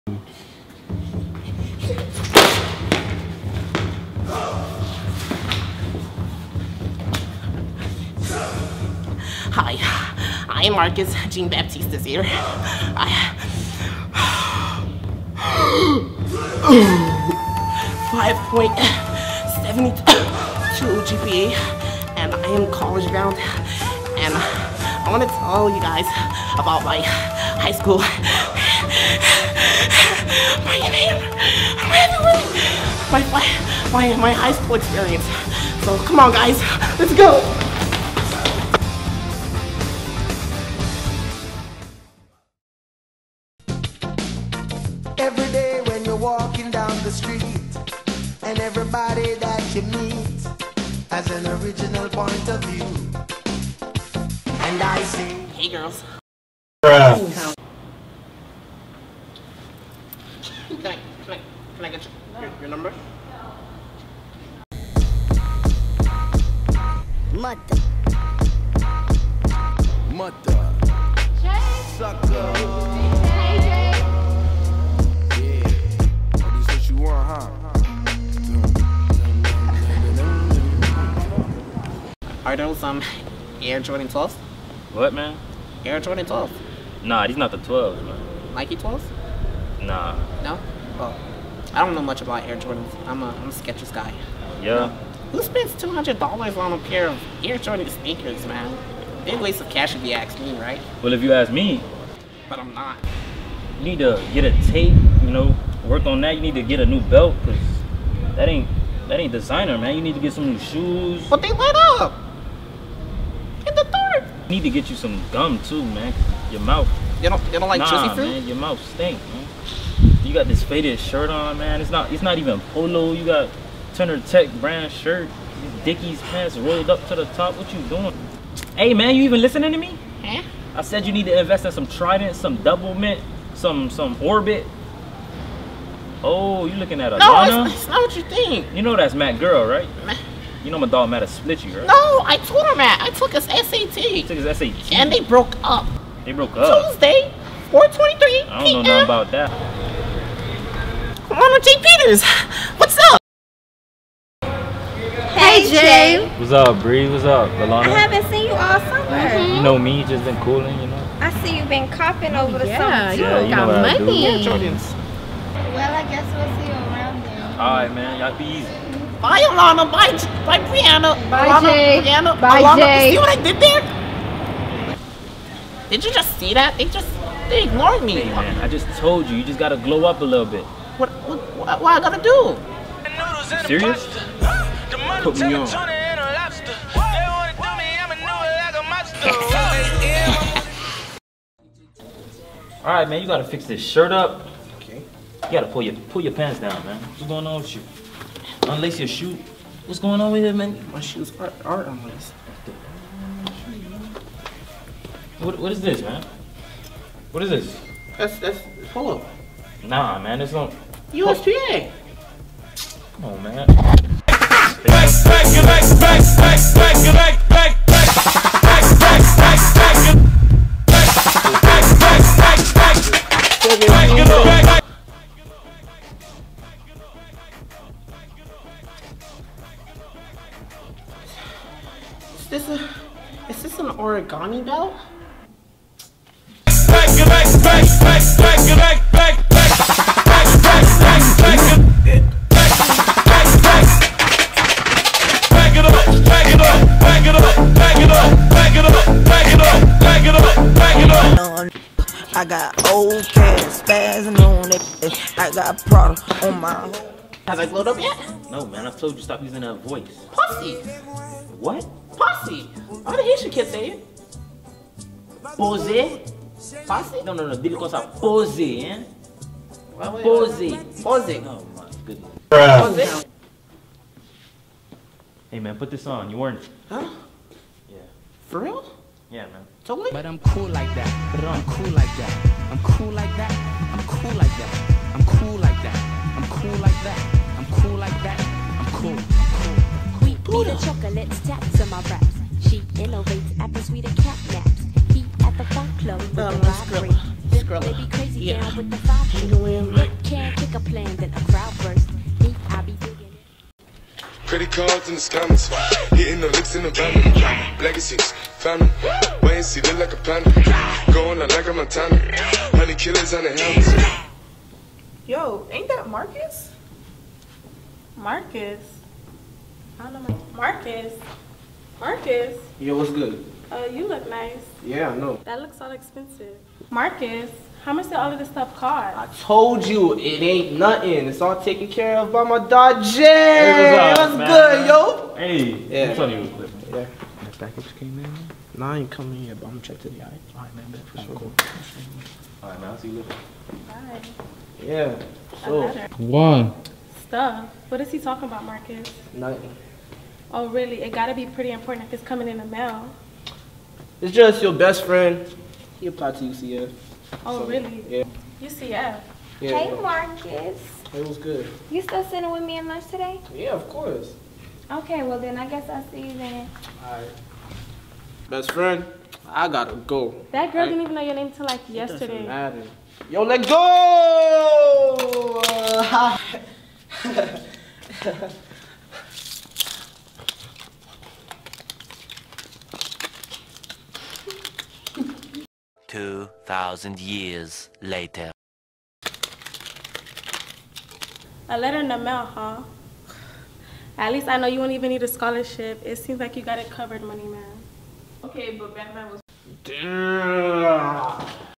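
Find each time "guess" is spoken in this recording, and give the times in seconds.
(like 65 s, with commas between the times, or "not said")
166 s, 365 s.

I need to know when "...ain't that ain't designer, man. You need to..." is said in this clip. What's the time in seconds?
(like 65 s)
108 s.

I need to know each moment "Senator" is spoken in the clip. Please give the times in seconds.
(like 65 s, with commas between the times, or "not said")
not said.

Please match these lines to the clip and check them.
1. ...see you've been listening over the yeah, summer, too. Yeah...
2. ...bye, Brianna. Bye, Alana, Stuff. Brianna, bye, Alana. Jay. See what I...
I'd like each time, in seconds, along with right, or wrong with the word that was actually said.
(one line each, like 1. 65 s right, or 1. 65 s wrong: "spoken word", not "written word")
1. 161 s wrong: "copping", not "listening"
2. 170 s wrong: "Jay", not "Stuff".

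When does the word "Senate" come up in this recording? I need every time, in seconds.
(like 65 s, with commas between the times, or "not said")
not said.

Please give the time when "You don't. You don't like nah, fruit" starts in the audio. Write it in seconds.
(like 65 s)
117 s.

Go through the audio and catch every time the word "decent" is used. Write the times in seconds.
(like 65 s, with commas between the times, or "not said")
not said.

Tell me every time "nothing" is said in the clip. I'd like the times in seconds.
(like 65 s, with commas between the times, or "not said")
148 s, 330 s, 349 s.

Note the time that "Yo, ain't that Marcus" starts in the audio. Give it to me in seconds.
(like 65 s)
315 s.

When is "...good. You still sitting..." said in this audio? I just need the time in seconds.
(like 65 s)
361 s.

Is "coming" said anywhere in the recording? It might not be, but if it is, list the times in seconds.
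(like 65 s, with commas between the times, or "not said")
339 s, 352 s.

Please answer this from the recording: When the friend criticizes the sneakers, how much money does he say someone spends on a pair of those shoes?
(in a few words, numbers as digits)
$200.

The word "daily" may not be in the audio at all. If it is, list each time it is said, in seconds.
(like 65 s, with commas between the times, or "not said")
not said.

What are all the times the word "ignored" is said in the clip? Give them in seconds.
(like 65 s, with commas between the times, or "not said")
177 s.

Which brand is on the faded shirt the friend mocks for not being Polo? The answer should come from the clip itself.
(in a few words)
Turner Tech.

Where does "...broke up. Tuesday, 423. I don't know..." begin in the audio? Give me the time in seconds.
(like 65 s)
146 s.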